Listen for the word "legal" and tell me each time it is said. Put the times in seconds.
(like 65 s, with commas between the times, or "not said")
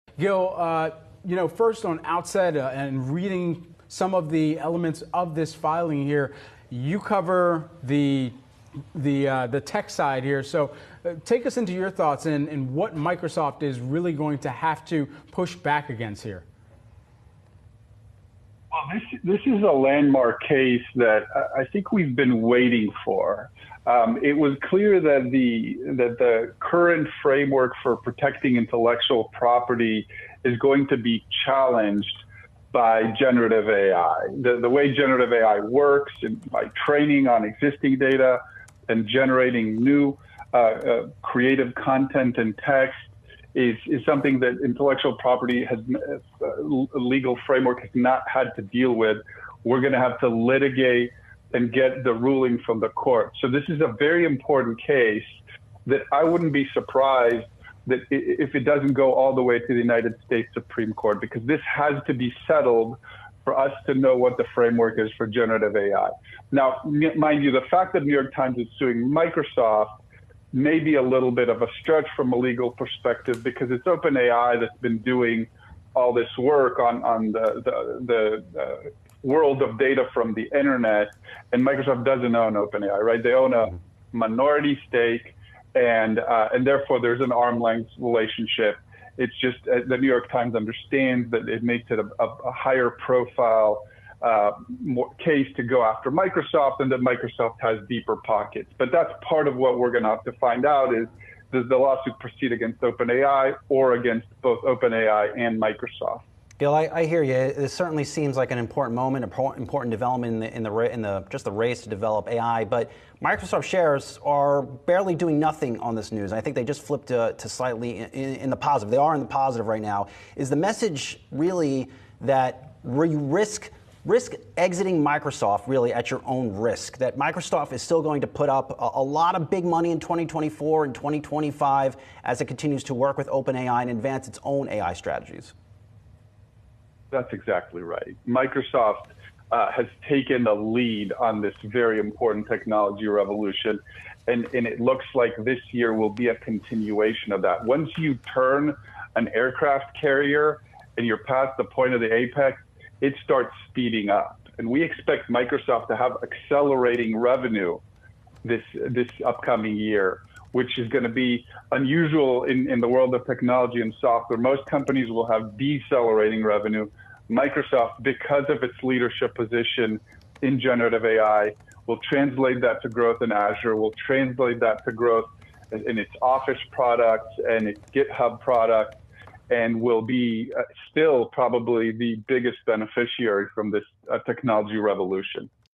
46 s, 72 s.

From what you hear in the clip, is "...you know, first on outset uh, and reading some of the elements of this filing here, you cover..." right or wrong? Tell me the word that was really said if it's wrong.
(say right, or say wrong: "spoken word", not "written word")
right.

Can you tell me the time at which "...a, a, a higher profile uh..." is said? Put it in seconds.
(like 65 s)
91 s.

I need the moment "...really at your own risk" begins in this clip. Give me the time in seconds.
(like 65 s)
125 s.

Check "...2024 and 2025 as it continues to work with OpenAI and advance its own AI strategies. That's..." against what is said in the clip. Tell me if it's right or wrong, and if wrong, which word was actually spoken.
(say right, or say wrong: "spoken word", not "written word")
right.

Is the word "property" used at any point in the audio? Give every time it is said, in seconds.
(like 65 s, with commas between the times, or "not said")
29 s, 45 s.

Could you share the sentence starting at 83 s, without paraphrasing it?
They own a minority stake, and, uh, and therefore there's an arm length relationship.